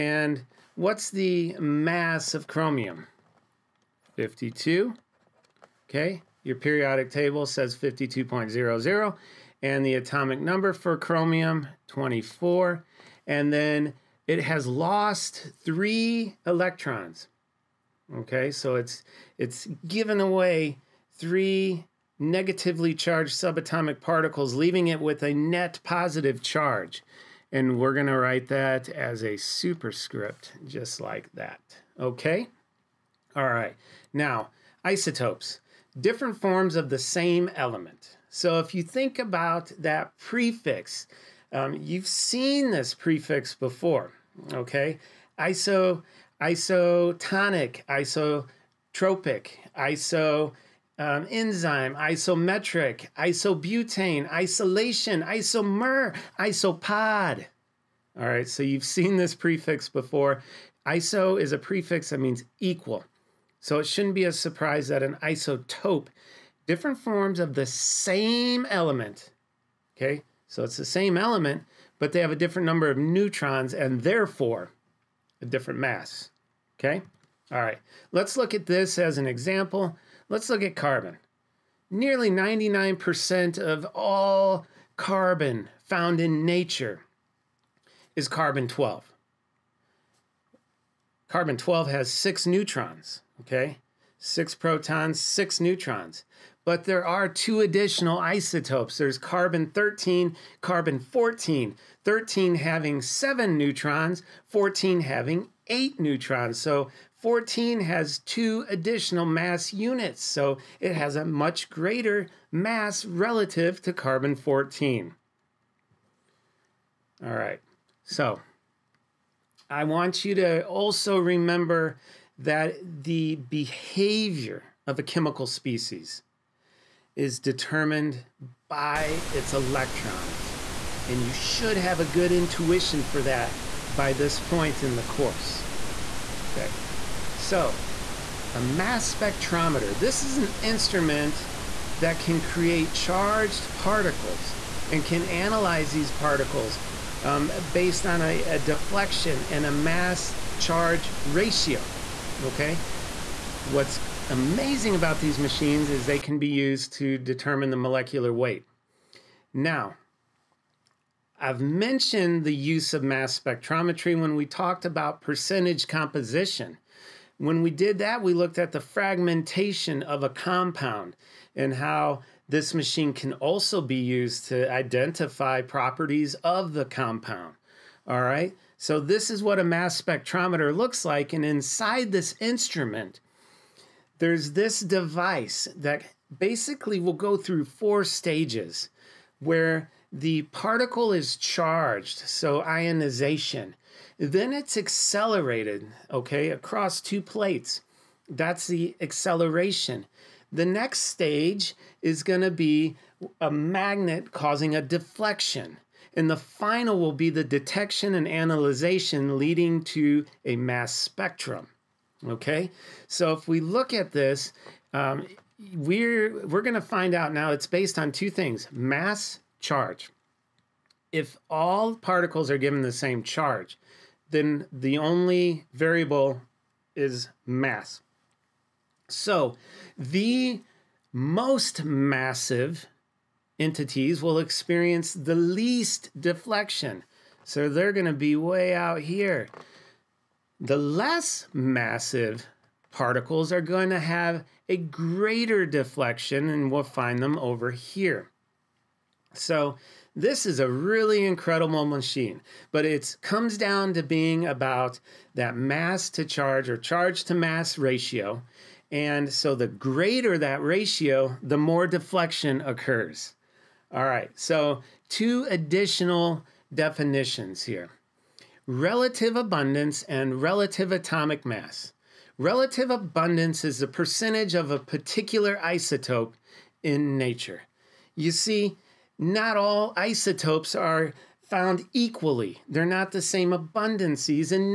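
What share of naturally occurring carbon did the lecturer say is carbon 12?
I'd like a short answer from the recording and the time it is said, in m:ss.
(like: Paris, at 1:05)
Nearly 99%, at 1:21.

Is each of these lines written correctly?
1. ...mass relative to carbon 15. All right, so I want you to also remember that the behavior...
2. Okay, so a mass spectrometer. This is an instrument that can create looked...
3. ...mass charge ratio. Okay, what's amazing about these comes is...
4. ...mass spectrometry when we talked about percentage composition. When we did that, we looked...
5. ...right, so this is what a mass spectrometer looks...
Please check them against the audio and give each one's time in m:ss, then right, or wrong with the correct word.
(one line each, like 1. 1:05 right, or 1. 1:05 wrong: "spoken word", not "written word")
1. 1:52 wrong: "14", not "15"
2. 2:16 wrong: "charged", not "looked"
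3. 2:29 wrong: "machines", not "comes"
4. 2:43 right
5. 2:58 right.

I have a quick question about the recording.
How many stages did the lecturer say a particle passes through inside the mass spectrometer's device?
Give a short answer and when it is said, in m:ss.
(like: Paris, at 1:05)
4, at 3:07.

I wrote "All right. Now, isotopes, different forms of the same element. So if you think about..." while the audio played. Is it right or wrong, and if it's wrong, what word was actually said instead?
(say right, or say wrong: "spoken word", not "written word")
right.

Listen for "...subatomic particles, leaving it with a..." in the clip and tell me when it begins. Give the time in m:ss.
0:23.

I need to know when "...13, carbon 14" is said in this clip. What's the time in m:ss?
1:39.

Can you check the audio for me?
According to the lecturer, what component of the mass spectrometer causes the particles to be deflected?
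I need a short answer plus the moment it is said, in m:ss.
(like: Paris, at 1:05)
A magnet, at 3:23.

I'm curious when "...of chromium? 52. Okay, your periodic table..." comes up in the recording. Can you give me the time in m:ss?
0:02.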